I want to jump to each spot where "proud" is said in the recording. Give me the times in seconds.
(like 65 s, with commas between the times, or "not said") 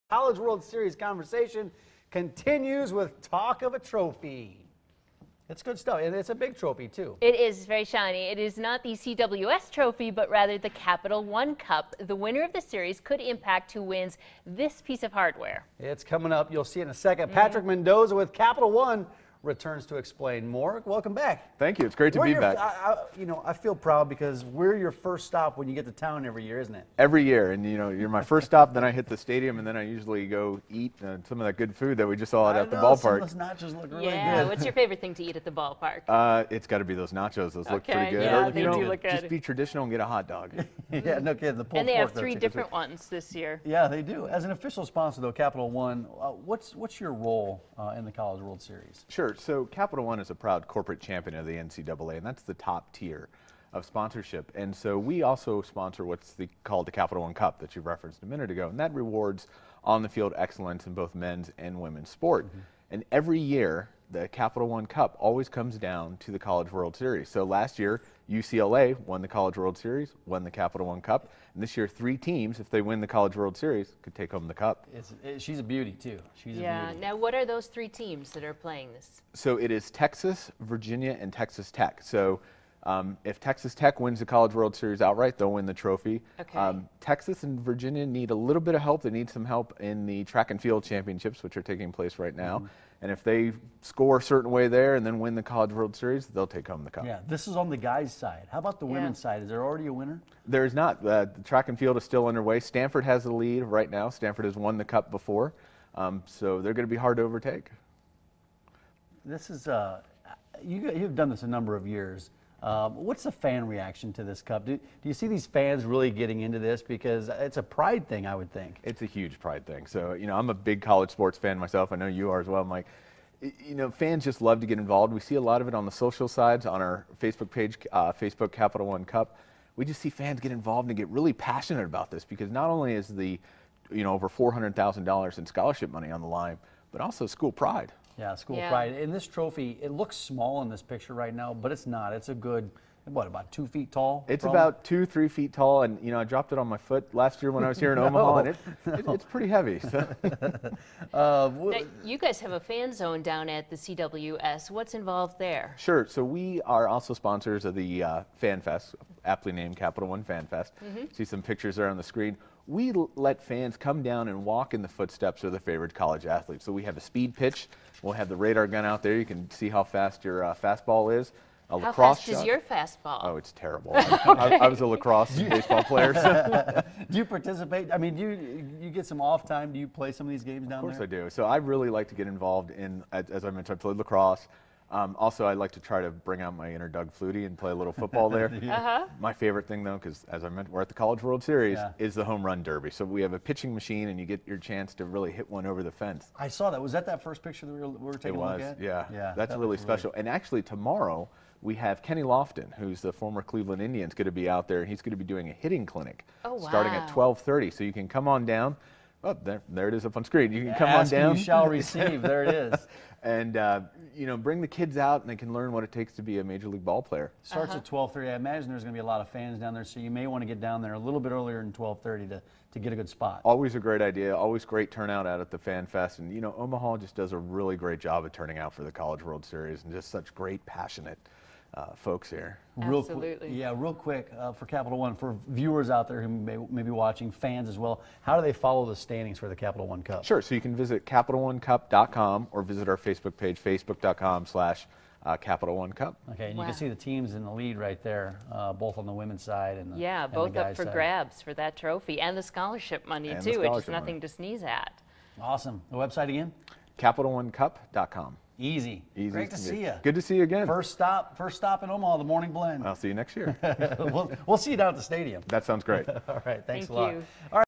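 23 s, 50 s.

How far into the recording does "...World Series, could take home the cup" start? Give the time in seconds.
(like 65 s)
73 s.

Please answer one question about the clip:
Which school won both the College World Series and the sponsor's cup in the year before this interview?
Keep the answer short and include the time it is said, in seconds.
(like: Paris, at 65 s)
UCLA, at 68 s.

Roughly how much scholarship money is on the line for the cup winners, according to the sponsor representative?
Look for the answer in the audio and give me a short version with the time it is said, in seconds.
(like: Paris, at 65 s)
over $400,000, at 134 s.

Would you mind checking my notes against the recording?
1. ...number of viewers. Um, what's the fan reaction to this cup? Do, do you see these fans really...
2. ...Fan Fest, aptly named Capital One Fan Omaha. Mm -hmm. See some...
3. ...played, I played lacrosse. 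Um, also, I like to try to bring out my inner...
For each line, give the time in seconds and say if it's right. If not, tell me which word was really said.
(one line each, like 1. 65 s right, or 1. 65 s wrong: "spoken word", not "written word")
1. 111 s wrong: "years", not "viewers"
2. 158 s wrong: "Fest", not "Omaha"
3. 183 s wrong: "mentioned", not "played".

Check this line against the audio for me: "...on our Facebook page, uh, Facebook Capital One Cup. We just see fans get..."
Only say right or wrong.
right.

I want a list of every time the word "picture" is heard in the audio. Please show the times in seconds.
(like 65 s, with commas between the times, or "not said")
140 s, 161 s, 197 s.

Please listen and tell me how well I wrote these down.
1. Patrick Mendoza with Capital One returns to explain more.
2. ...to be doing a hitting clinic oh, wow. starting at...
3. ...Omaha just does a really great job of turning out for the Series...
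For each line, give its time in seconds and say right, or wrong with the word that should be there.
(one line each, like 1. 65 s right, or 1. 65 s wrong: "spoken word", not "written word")
1. 17 s right
2. 205 s right
3. 226 s wrong: "College", not "Series".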